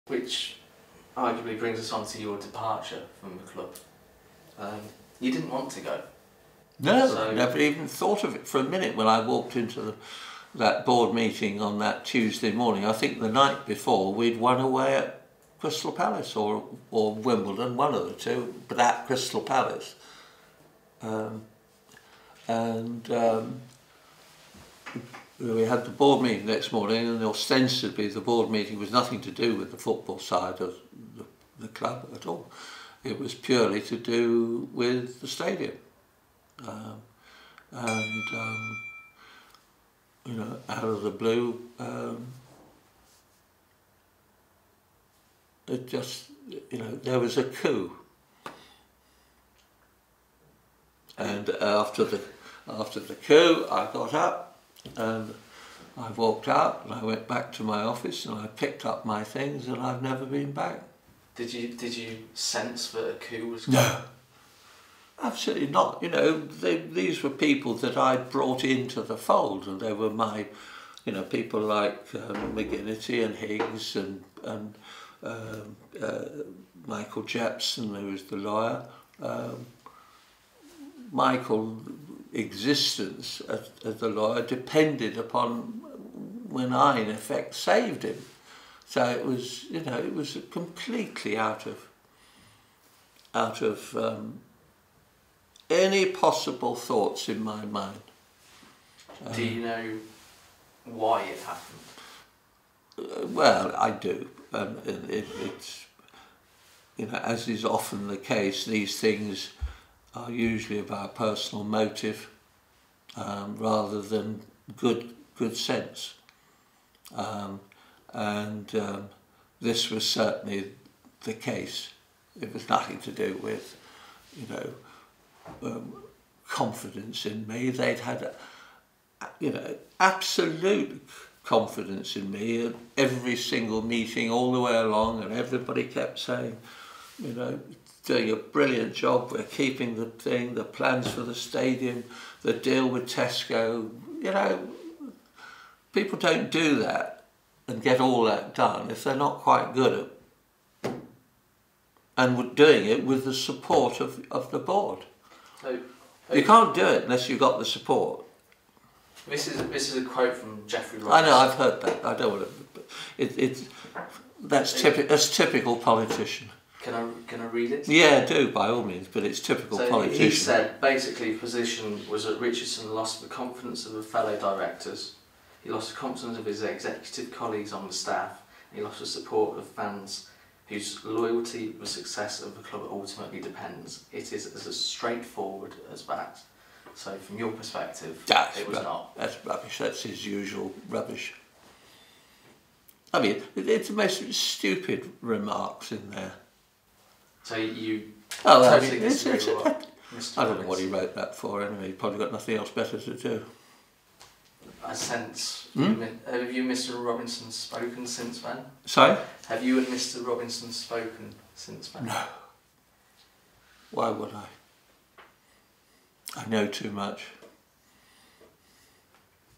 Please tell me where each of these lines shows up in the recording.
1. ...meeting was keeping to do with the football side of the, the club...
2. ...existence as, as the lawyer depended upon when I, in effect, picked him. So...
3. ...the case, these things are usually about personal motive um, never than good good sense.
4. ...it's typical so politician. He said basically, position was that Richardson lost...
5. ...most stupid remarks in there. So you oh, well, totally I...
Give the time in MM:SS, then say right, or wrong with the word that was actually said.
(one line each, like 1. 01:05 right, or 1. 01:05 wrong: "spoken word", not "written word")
1. 00:28 wrong: "nothing", not "keeping"
2. 01:22 wrong: "saved", not "picked"
3. 01:48 wrong: "rather", not "never"
4. 02:49 right
5. 03:13 right.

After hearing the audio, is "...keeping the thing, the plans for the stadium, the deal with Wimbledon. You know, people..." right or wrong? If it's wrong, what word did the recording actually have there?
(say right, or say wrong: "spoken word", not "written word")
wrong: "Tesco", not "Wimbledon".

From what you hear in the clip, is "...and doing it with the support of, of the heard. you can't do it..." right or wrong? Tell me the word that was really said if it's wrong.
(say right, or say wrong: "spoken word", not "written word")
wrong: "board", not "heard".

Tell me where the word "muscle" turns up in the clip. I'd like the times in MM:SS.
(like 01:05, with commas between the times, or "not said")
not said.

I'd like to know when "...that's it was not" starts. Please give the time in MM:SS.
03:08.